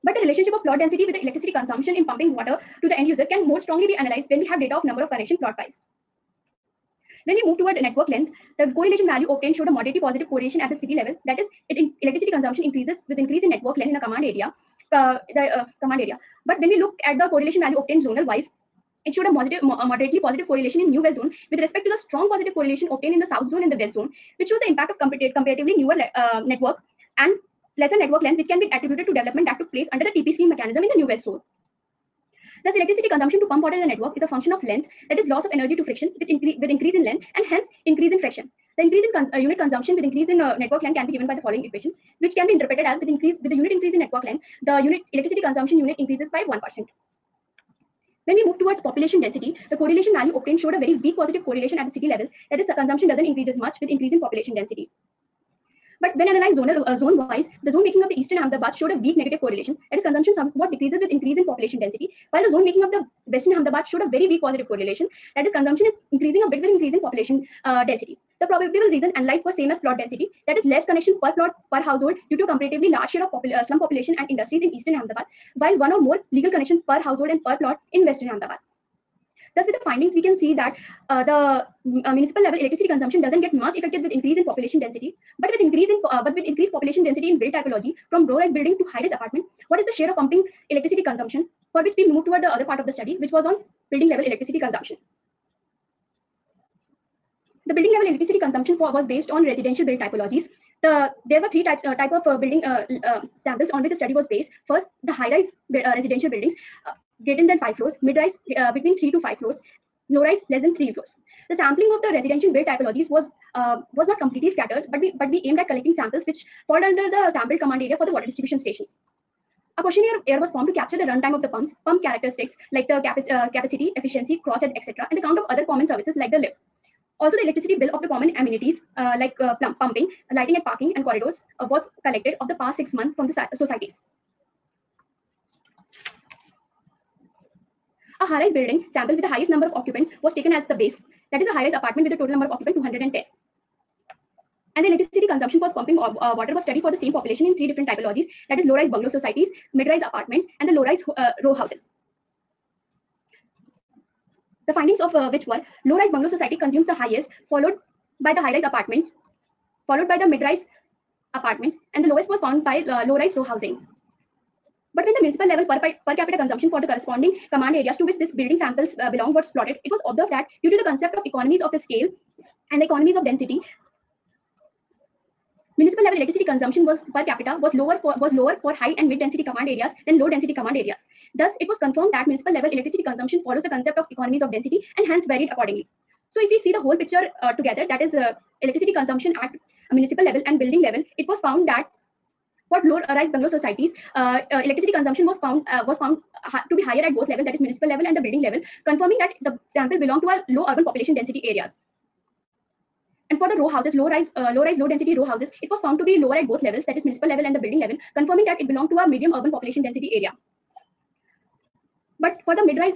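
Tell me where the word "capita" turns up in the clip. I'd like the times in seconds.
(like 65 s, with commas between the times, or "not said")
166 s, 177 s.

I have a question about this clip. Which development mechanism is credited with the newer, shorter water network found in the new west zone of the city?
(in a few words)
TP scheme.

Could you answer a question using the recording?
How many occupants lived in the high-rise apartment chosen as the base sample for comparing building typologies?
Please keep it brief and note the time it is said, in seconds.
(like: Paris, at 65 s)
210, at 142 s.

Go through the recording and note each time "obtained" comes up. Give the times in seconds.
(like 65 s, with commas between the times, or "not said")
9 s, 17 s, 22 s, 50 s.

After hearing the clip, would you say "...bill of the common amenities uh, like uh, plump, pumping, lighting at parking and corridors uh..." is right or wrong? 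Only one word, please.
right.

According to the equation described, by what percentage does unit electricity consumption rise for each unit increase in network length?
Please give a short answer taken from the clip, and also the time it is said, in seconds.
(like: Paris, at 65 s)
1%, at 46 s.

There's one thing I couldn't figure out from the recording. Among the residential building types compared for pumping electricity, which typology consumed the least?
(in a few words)
Low-rise row housing.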